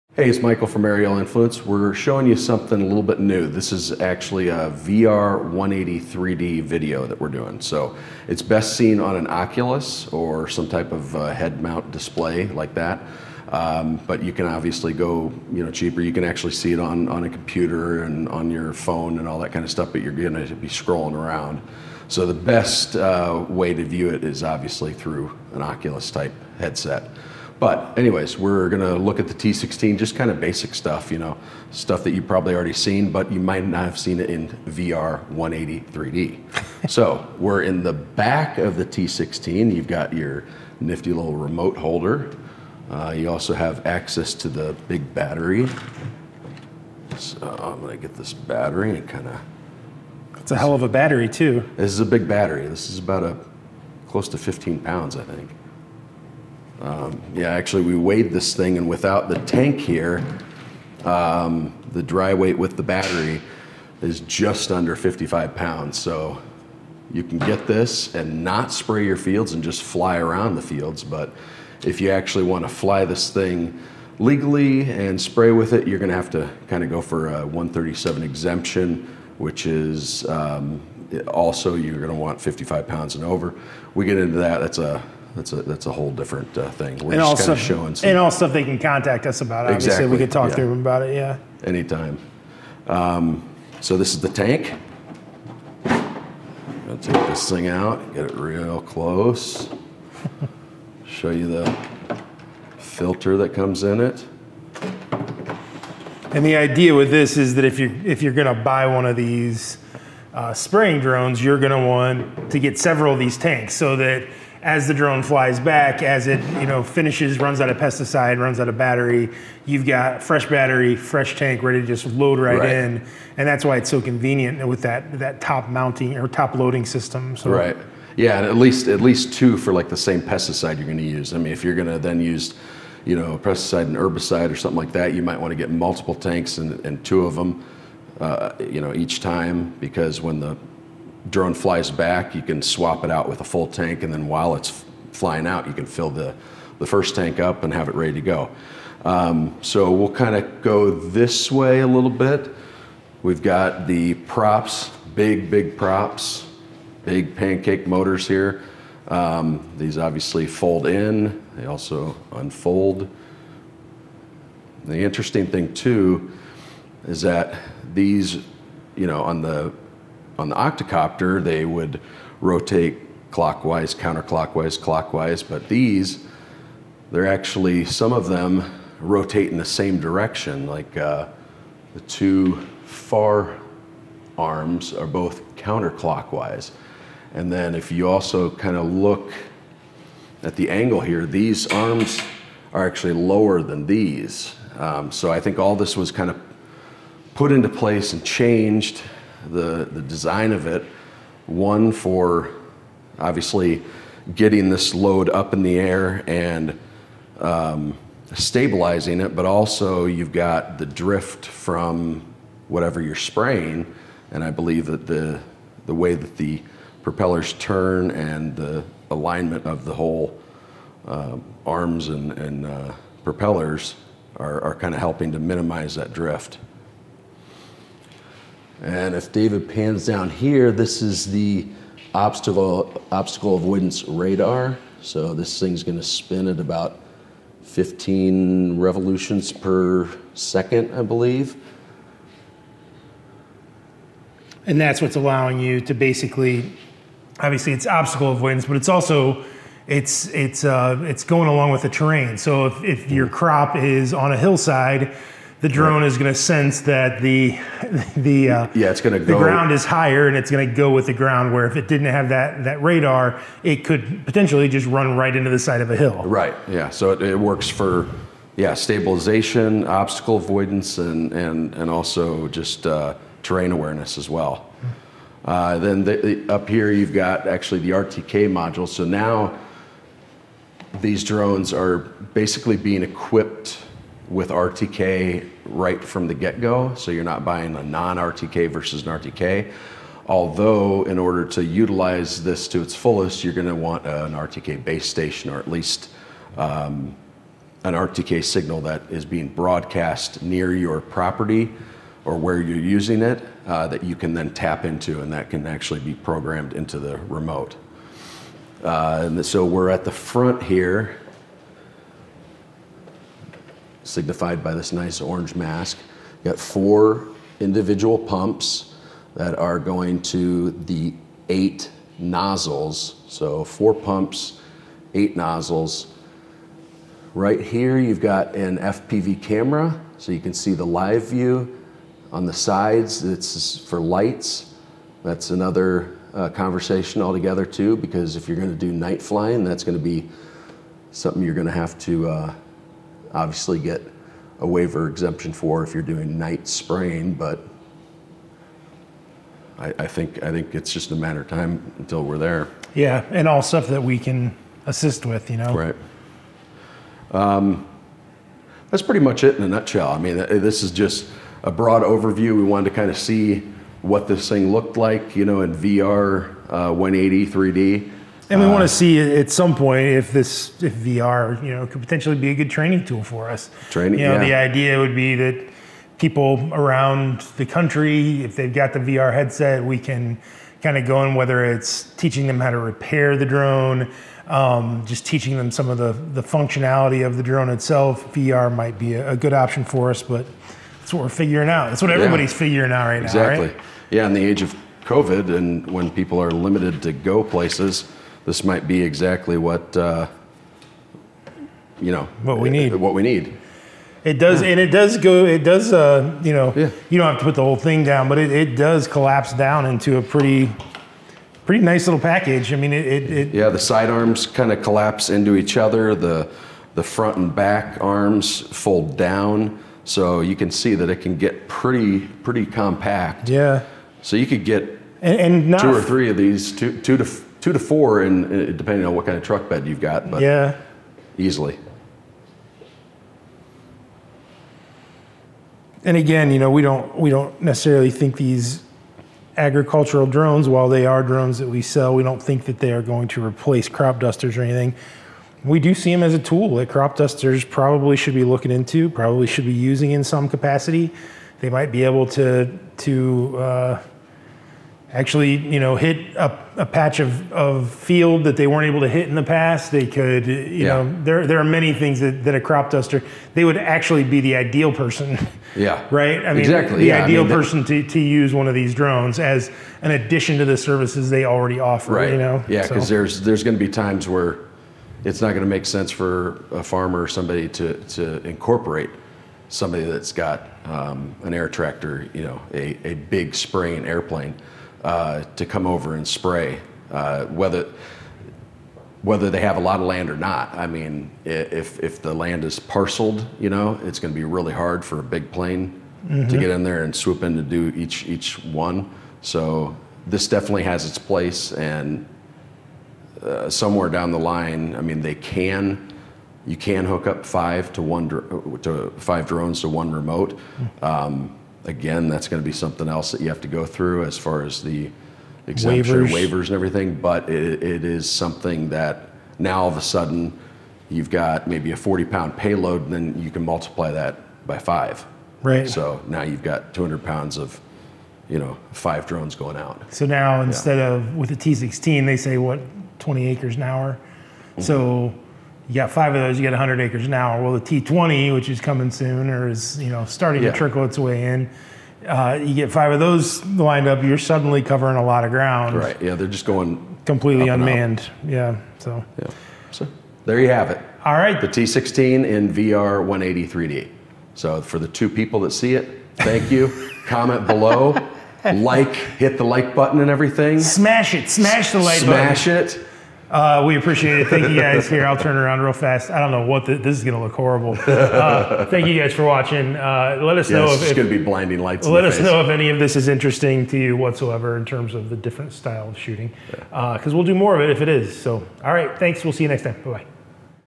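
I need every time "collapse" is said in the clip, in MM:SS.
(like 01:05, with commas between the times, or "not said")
06:49, 06:54.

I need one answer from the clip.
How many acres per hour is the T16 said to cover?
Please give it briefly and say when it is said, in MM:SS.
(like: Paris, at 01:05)
20 acres an hour, at 08:53.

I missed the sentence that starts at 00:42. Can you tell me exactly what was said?
Uh, you also have access to the big battery.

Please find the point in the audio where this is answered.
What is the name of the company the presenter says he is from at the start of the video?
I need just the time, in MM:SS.
00:00.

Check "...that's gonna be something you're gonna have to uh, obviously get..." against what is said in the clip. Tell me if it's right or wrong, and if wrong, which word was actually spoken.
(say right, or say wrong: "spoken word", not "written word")
right.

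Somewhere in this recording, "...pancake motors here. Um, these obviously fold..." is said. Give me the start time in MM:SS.
02:37.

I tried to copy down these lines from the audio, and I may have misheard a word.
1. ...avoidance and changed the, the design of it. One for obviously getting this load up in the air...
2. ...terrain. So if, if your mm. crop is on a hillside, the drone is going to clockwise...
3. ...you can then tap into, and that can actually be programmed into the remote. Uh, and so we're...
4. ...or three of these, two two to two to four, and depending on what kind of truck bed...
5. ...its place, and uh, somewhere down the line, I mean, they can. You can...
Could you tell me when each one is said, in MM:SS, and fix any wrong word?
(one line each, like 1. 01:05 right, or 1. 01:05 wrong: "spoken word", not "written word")
1. 03:17 wrong: "place", not "avoidance"
2. 04:11 wrong: "sense", not "clockwise"
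3. 05:04 right
4. 07:05 right
5. 08:21 right.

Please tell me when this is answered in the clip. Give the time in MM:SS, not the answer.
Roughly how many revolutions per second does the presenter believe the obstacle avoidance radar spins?
03:57.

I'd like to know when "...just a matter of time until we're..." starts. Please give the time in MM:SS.
05:50.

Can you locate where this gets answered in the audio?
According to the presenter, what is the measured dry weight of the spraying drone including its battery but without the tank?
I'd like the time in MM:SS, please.
01:04.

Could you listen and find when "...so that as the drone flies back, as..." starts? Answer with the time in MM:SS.
01:53.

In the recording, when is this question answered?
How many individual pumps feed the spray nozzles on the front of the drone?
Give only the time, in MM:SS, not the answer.
05:16.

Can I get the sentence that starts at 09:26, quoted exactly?
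I don't know what the, this is going to look horrible.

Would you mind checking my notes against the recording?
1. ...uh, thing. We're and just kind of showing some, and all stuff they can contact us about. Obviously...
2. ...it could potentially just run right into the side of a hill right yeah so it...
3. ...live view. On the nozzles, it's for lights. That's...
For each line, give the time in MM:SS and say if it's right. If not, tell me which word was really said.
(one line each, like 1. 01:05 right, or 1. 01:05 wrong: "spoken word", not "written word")
1. 01:26 right
2. 04:23 right
3. 05:30 wrong: "sides", not "nozzles".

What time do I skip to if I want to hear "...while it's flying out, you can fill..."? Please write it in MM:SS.
02:24.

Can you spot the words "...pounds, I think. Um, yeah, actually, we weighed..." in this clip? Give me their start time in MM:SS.
00:54.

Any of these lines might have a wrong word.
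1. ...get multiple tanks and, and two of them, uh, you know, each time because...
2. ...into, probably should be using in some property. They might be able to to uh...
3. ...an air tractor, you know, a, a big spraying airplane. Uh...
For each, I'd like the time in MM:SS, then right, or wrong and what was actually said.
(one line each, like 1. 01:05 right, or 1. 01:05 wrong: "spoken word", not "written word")
1. 02:15 right
2. 07:28 wrong: "capacity", not "property"
3. 08:01 right.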